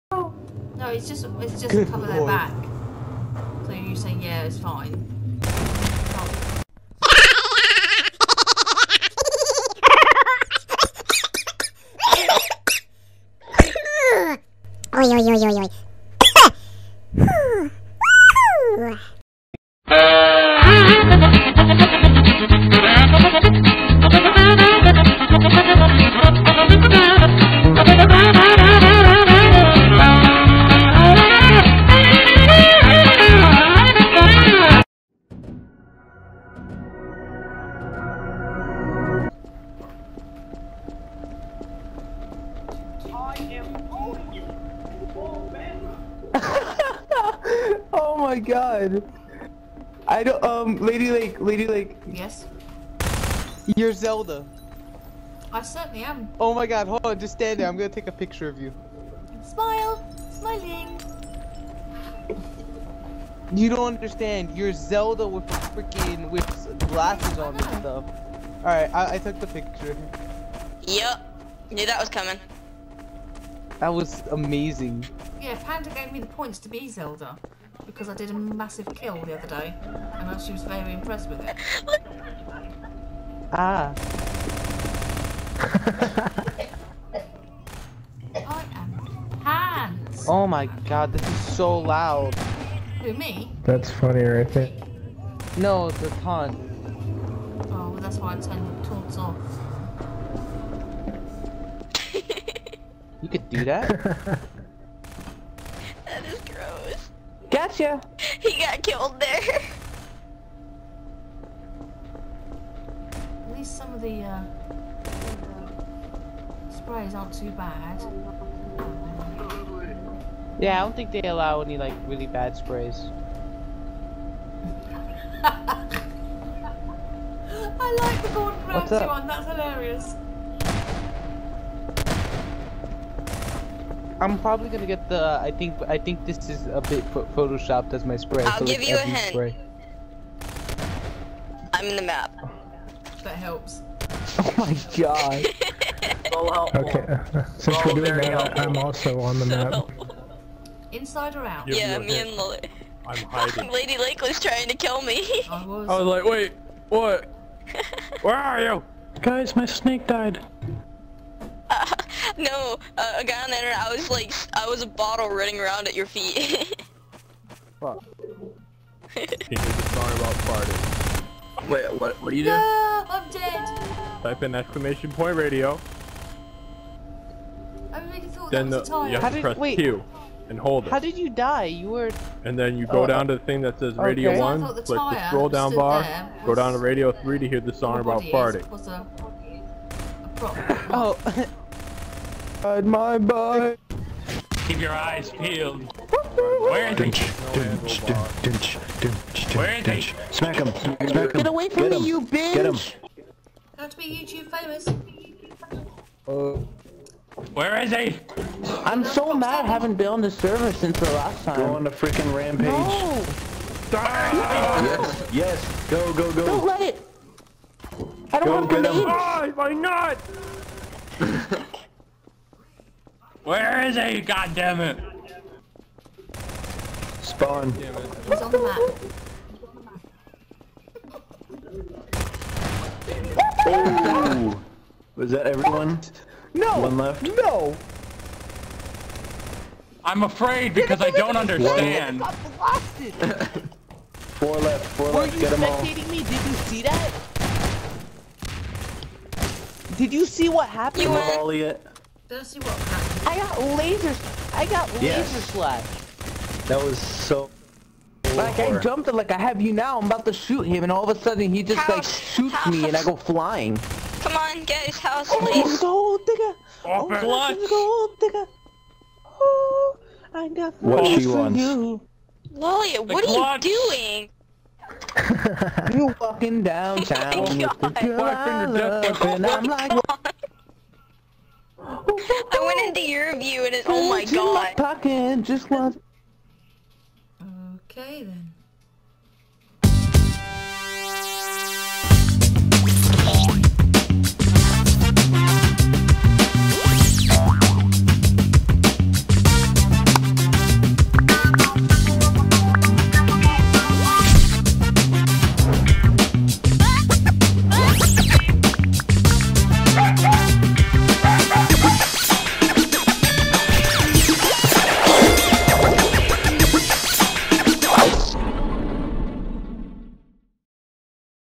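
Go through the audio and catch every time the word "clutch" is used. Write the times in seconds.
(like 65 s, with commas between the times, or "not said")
267 s, 273 s.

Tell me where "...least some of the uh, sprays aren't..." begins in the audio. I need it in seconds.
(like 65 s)
113 s.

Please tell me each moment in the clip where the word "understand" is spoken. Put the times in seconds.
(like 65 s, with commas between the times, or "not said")
63 s, 241 s.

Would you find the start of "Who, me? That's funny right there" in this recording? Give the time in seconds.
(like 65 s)
93 s.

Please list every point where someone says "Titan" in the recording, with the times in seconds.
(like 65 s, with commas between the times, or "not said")
not said.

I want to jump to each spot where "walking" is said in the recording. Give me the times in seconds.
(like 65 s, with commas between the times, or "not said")
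276 s.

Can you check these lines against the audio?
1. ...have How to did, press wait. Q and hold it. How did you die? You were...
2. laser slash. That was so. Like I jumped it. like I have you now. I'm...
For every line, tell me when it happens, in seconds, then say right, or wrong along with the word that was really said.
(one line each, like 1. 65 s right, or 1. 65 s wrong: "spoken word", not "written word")
1. 179 s right
2. 255 s right.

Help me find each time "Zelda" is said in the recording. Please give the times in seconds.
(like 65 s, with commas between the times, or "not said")
53 s, 64 s, 76 s.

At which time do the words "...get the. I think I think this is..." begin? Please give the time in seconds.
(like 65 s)
134 s.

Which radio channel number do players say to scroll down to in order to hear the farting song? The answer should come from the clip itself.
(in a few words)
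3.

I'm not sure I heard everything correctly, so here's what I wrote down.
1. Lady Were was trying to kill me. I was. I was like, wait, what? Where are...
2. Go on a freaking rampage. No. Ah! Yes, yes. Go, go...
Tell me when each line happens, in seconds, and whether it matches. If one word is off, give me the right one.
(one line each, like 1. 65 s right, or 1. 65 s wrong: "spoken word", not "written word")
1. 153 s wrong: "Lake", not "Were"
2. 211 s right.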